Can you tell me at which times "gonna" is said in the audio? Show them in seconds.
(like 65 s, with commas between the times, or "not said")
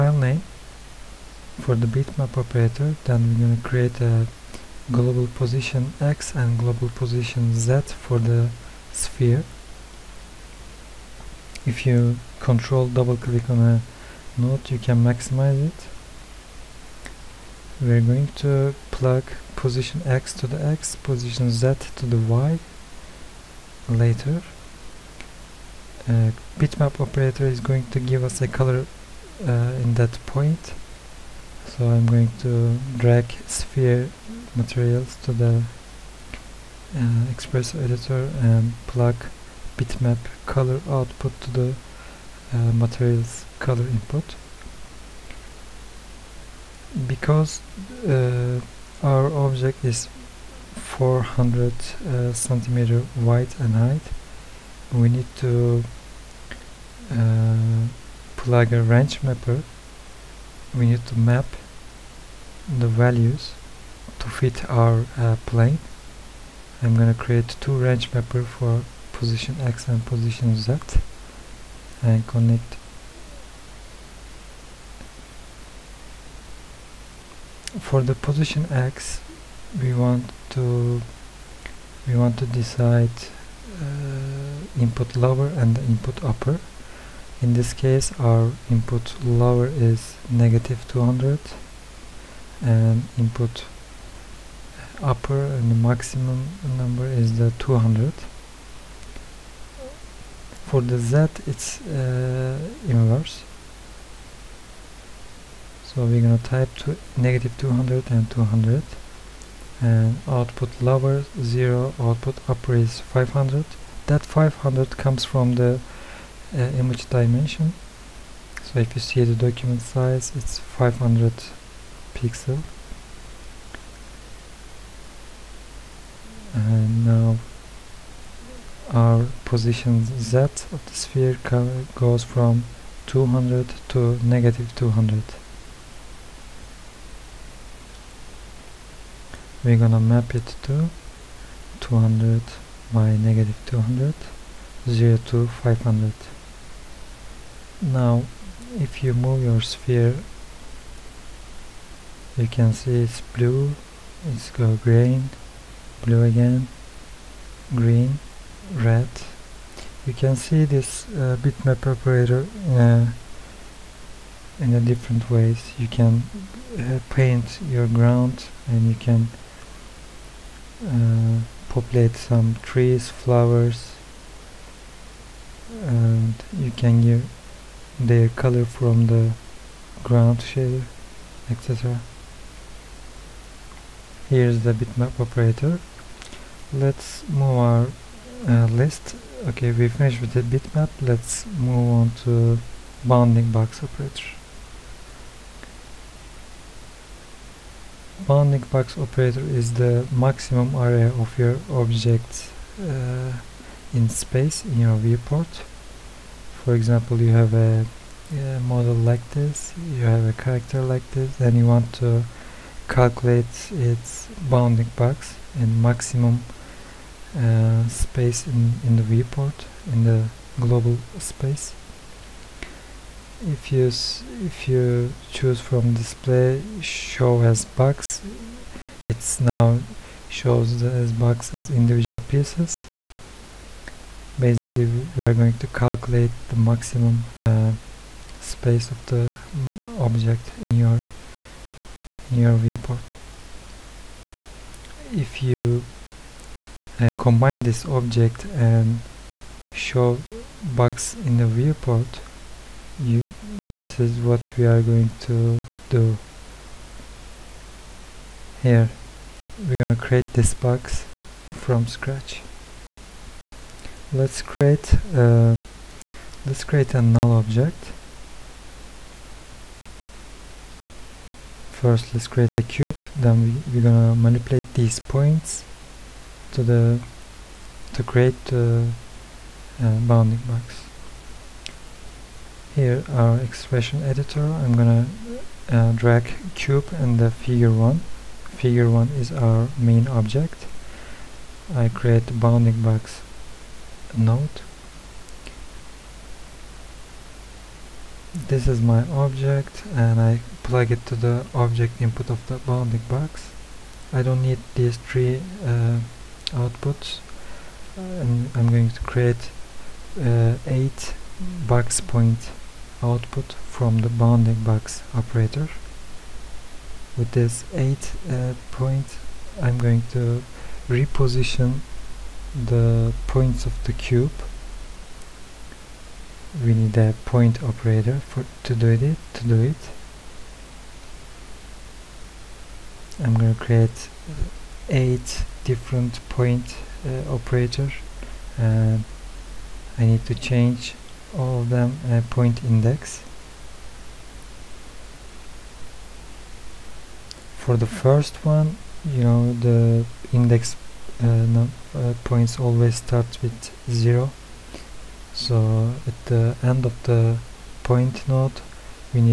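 66 s, 106 s, 139 s, 259 s, 273 s, 284 s, 333 s.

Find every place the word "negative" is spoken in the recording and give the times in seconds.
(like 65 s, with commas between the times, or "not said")
90 s, 107 s, 134 s, 143 s.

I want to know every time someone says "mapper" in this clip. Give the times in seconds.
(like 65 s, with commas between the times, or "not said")
59 s, 68 s.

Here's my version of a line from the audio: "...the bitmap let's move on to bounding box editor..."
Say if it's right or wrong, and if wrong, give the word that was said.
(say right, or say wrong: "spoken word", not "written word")
wrong: "operator", not "editor".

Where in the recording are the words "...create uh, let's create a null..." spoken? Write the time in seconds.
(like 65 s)
264 s.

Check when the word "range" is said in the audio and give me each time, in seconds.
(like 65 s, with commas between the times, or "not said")
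58 s, 67 s.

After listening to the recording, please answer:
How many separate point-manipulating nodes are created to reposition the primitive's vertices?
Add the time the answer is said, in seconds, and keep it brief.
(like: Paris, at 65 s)
8, at 334 s.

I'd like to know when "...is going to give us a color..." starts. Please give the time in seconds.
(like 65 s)
27 s.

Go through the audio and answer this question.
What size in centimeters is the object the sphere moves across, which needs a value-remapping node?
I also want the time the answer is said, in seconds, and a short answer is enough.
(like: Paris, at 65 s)
400, at 50 s.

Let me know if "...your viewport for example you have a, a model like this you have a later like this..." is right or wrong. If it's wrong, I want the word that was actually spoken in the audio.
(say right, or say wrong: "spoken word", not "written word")
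wrong: "character", not "later".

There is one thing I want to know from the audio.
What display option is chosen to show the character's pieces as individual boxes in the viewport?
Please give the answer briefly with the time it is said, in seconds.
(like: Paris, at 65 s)
show as box, at 226 s.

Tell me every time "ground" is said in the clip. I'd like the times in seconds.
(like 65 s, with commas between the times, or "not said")
167 s, 180 s.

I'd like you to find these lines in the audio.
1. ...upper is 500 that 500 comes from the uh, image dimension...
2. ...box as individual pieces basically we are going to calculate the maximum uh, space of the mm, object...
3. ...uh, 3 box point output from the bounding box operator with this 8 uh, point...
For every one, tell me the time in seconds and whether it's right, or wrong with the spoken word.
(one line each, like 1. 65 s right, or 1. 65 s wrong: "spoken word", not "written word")
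1. 112 s right
2. 231 s right
3. 310 s wrong: "8", not "3".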